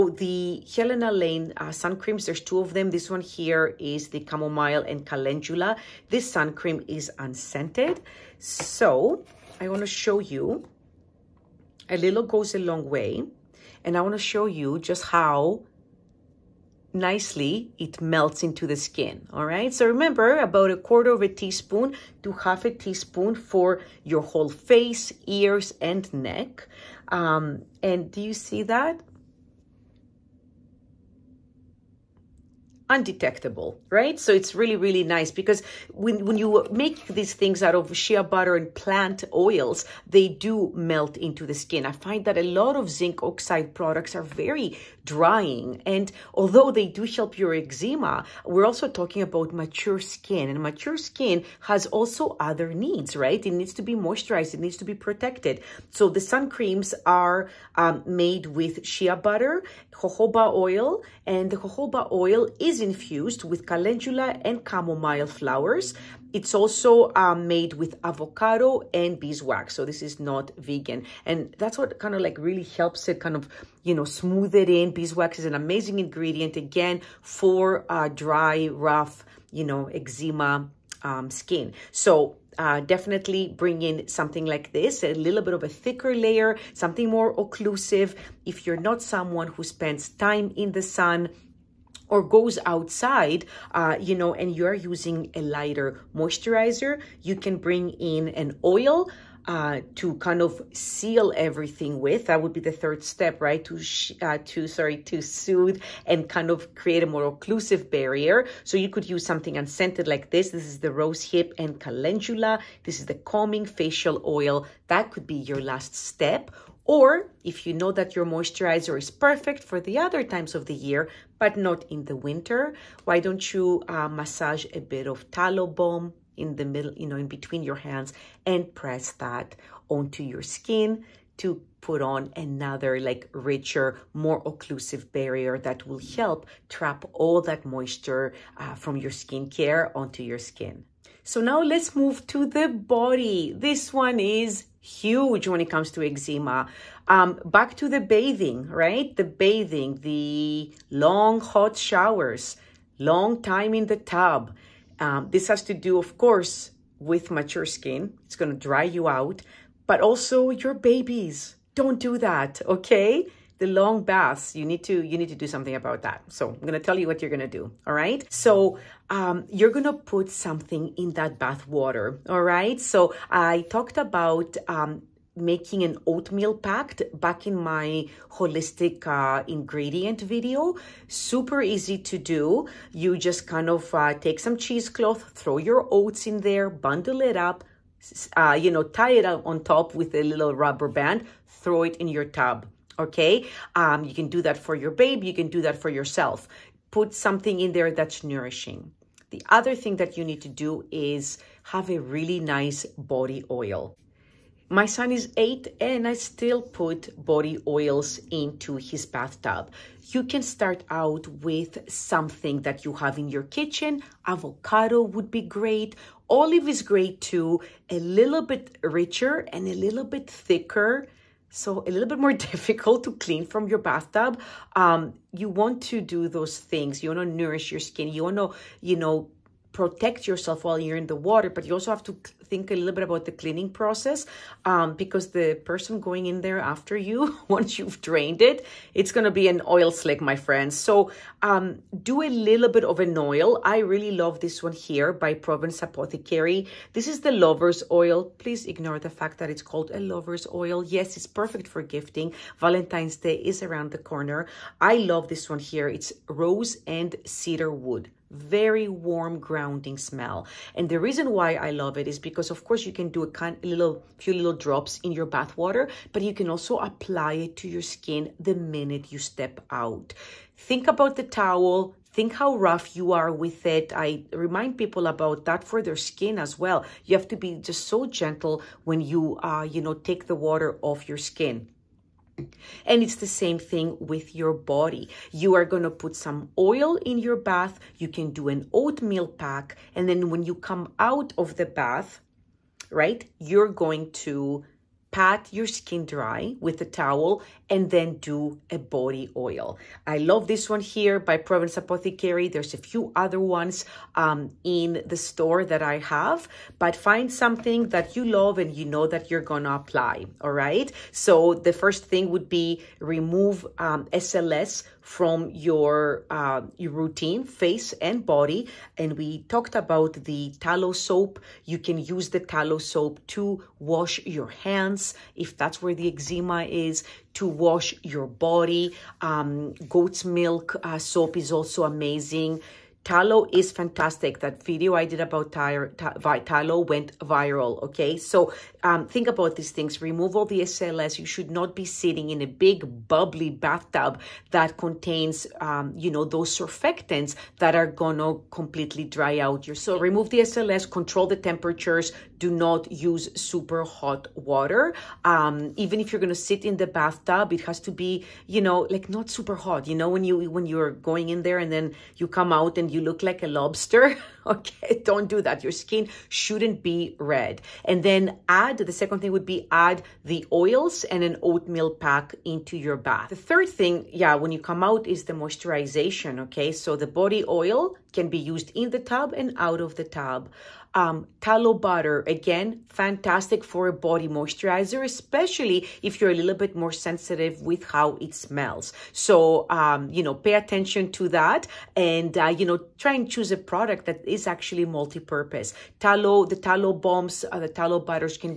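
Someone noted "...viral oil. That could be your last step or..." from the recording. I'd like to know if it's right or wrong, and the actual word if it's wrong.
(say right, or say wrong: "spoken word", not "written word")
wrong: "facial", not "viral".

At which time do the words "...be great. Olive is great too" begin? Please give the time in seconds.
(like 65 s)
215 s.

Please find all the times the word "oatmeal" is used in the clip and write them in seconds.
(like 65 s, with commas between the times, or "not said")
176 s, 288 s, 371 s.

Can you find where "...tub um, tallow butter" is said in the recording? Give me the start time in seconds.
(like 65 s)
380 s.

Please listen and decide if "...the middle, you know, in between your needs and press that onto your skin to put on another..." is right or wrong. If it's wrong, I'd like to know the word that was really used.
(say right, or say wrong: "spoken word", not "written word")
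wrong: "hands", not "needs".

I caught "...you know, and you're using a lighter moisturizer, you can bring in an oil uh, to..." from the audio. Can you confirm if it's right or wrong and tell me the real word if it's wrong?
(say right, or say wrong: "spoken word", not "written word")
right.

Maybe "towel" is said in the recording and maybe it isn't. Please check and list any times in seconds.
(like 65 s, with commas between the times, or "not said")
271 s, 296 s.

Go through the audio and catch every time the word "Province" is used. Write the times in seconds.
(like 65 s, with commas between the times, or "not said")
245 s, 301 s.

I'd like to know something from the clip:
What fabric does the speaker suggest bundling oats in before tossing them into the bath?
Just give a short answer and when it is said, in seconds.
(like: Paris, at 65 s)
Cheesecloth, at 184 s.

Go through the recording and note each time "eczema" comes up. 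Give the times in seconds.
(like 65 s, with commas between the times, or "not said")
47 s, 79 s, 146 s, 326 s.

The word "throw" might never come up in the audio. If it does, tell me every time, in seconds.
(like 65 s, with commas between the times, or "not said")
185 s, 191 s.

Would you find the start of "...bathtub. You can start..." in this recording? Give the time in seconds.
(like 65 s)
209 s.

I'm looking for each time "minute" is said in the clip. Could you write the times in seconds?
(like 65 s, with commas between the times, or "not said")
268 s.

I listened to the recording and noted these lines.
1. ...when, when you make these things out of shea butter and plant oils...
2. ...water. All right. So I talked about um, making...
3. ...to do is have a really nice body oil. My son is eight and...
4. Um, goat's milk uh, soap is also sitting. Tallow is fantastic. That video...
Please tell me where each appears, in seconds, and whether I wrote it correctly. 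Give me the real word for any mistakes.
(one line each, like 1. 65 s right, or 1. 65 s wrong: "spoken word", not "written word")
1. 35 s right
2. 171 s right
3. 200 s right
4. 329 s wrong: "amazing", not "sitting".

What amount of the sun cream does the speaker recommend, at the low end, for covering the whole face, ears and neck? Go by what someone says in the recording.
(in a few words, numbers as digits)
1/4 teaspoon.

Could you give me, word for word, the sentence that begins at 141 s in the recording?
So now let's move to the body.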